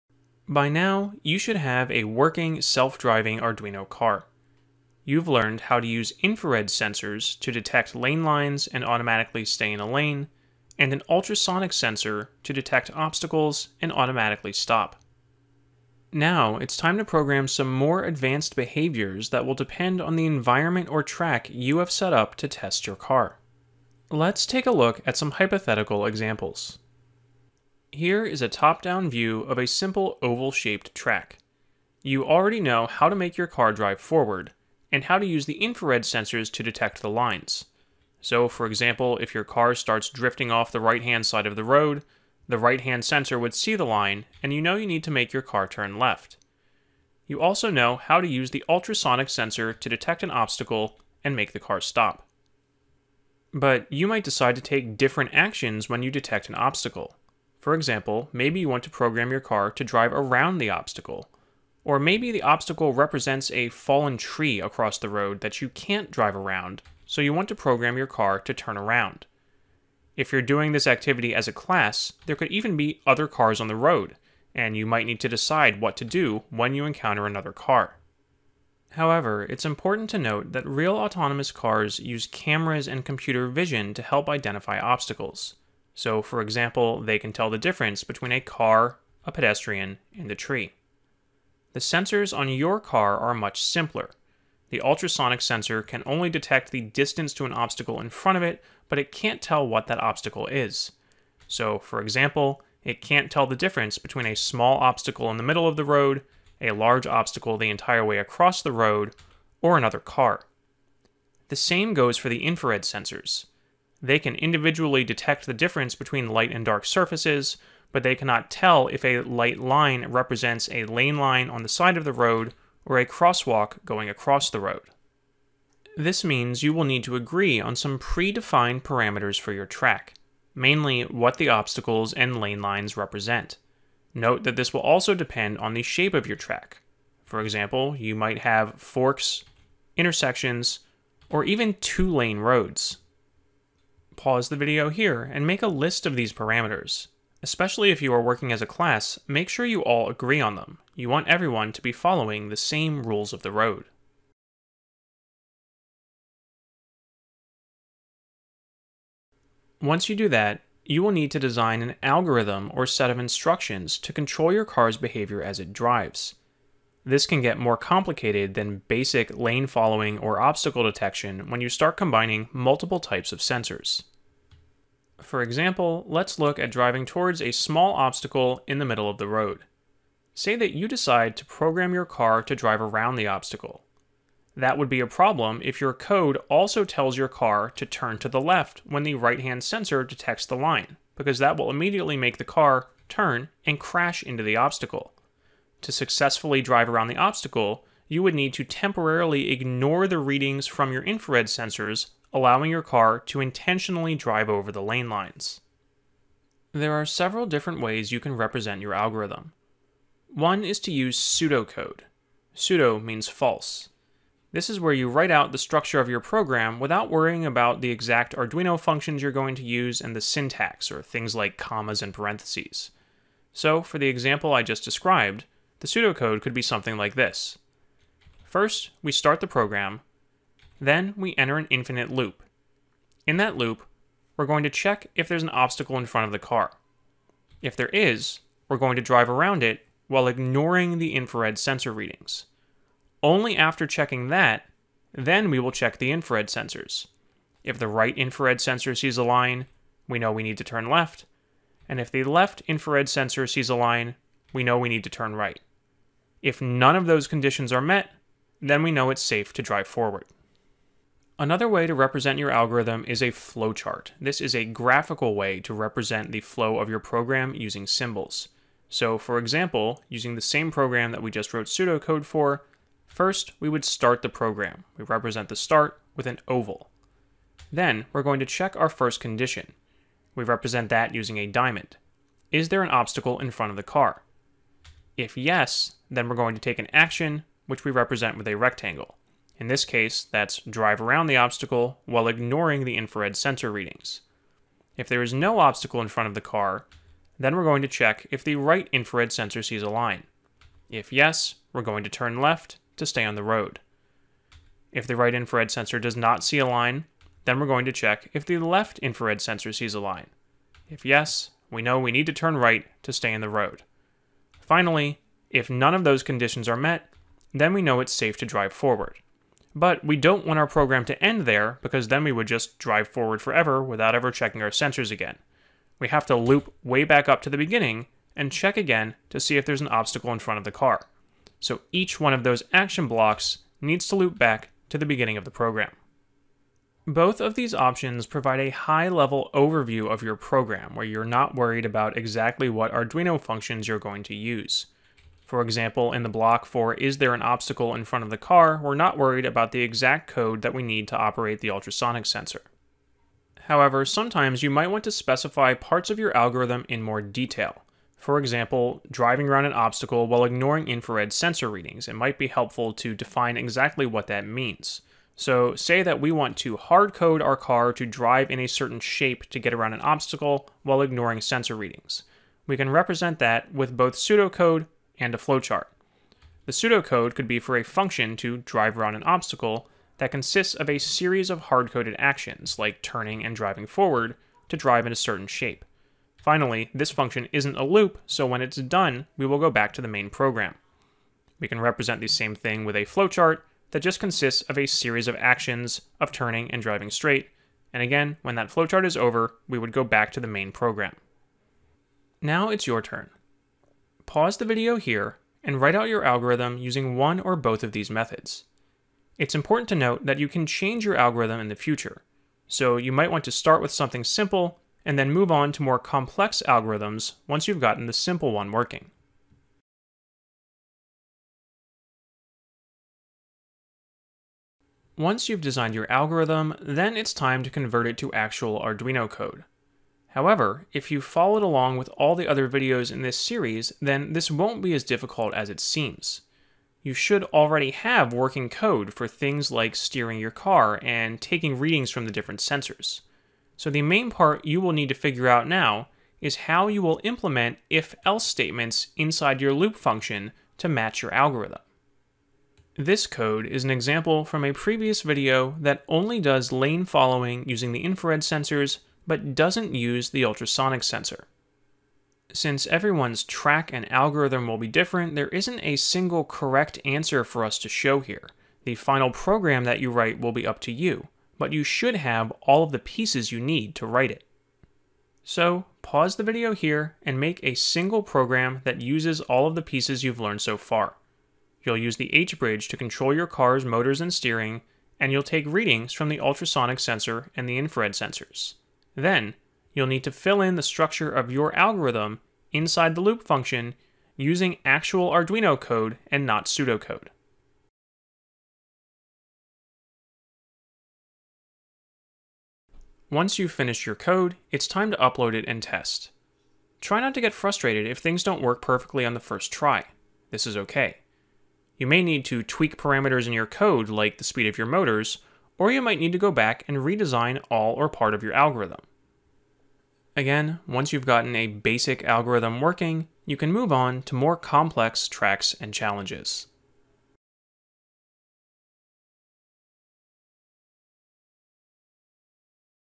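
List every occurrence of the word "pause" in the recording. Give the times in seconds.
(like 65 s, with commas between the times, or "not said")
144 s, 404 s, 476 s.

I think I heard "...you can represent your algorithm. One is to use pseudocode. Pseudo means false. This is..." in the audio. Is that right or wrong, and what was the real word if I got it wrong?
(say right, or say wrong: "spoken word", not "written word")
right.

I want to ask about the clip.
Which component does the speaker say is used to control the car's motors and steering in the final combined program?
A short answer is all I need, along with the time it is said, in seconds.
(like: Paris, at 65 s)
H-bridge, at 482 s.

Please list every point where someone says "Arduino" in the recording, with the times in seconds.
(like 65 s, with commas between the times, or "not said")
3 s, 218 s, 342 s, 428 s, 495 s.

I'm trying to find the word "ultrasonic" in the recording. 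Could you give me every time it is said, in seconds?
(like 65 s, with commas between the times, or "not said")
11 s, 48 s, 94 s, 351 s, 460 s, 486 s.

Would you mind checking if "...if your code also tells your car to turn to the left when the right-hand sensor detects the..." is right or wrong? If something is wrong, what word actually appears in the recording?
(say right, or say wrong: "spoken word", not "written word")
right.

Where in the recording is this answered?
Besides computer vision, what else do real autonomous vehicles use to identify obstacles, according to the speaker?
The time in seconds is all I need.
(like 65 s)
82 s.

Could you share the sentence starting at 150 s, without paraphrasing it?
You want everyone to be following the same rules of the road.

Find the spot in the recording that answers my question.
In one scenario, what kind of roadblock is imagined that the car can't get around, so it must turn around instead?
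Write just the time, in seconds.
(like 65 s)
63 s.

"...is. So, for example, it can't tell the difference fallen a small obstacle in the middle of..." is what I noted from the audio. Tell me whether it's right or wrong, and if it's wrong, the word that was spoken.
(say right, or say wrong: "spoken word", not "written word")
wrong: "between", not "fallen".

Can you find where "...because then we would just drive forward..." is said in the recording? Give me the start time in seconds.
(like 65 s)
321 s.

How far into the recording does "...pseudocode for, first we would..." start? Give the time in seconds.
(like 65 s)
271 s.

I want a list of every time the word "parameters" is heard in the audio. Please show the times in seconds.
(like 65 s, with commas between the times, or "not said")
128 s, 146 s, 512 s.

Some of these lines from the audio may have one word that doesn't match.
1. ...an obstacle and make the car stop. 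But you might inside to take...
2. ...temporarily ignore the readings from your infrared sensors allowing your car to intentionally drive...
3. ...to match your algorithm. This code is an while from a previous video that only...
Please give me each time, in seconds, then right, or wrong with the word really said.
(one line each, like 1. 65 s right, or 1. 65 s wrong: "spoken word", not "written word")
1. 50 s wrong: "decide", not "inside"
2. 198 s right
3. 450 s wrong: "example", not "while".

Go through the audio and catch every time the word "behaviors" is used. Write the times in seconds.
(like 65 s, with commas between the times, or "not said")
18 s, 164 s.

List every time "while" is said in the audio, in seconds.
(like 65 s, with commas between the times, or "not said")
240 s, 292 s, 360 s, 370 s.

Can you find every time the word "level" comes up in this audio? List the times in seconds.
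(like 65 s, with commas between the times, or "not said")
338 s.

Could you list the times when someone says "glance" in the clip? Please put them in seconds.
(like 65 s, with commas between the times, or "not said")
not said.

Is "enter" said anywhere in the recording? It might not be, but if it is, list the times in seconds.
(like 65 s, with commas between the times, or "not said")
231 s.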